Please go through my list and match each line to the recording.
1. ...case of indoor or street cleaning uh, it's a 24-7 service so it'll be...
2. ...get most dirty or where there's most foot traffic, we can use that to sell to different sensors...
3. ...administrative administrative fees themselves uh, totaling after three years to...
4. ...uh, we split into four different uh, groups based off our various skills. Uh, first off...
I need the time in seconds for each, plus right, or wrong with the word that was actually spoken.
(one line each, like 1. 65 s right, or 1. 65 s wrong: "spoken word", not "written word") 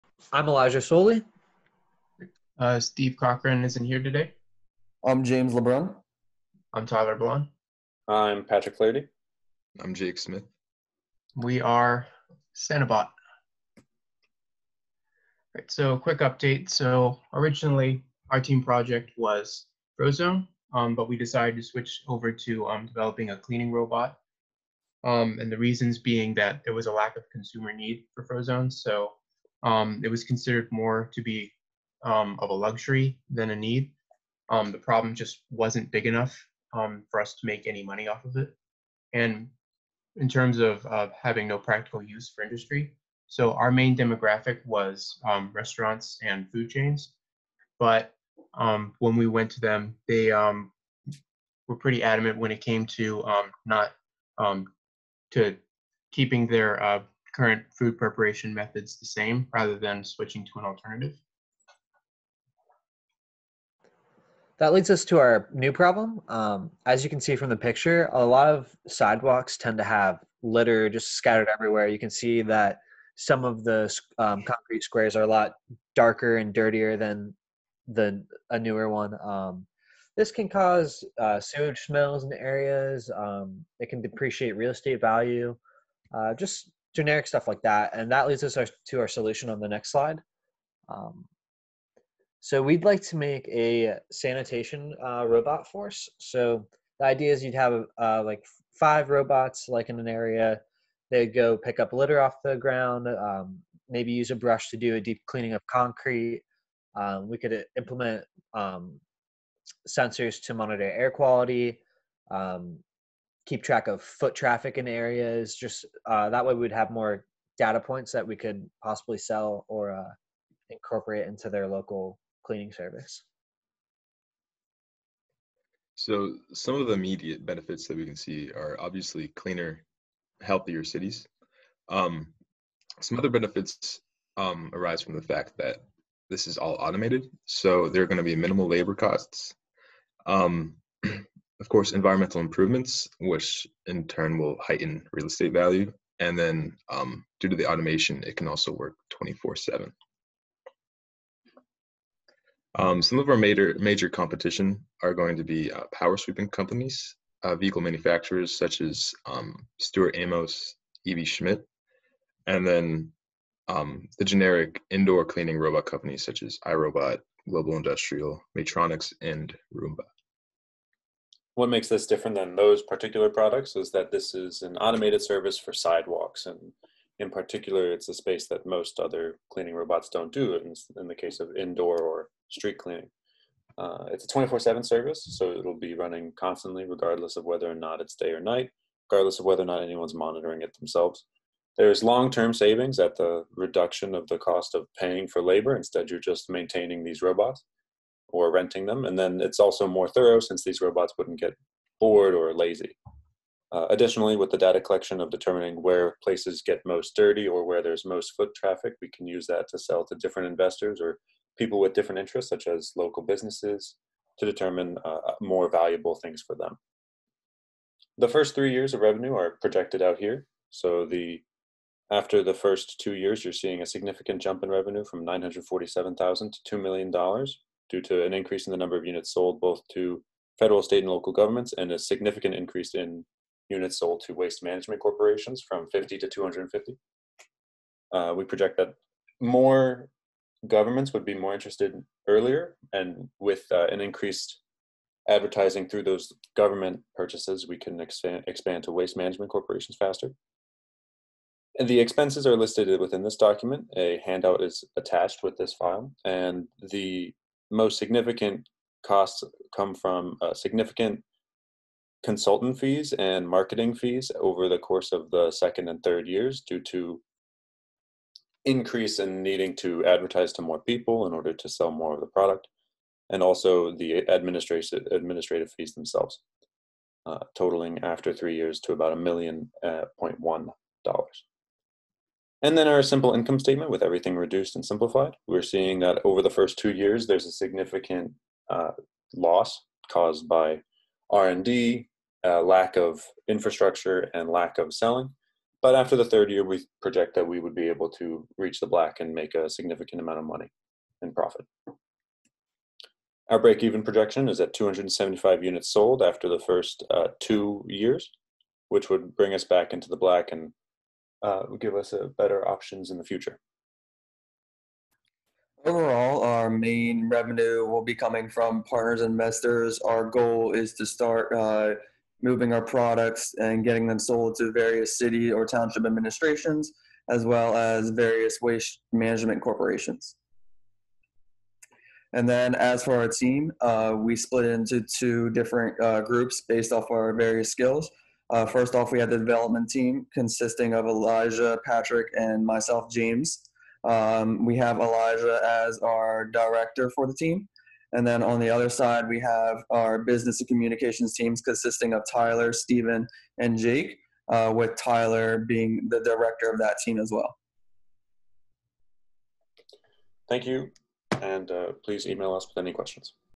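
1. 181 s right
2. 206 s wrong: "investors", not "sensors"
3. 274 s right
4. 333 s wrong: "two", not "four".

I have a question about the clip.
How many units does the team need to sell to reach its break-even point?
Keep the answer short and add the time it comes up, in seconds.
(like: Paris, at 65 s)
275, at 304 s.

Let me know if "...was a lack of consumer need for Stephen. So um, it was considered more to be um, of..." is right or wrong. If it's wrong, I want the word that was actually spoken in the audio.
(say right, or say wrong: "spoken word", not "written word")
wrong: "Frozone", not "Stephen".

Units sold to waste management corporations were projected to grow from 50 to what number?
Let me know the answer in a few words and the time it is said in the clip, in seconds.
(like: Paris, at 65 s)
250, at 236 s.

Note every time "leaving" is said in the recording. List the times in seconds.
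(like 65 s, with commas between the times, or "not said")
not said.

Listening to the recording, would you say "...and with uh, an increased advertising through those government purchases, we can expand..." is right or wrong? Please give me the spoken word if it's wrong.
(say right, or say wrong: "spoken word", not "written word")
right.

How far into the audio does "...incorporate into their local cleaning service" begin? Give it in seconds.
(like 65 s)
120 s.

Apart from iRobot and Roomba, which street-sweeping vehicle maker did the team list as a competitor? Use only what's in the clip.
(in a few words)
Aebi Schmidt.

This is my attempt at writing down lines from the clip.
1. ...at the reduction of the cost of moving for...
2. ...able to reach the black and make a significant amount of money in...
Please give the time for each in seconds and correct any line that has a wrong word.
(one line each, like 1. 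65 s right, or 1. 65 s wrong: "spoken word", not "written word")
1. 192 s wrong: "paying", not "moving"
2. 297 s right.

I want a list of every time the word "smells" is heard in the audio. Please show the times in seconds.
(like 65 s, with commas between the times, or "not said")
81 s.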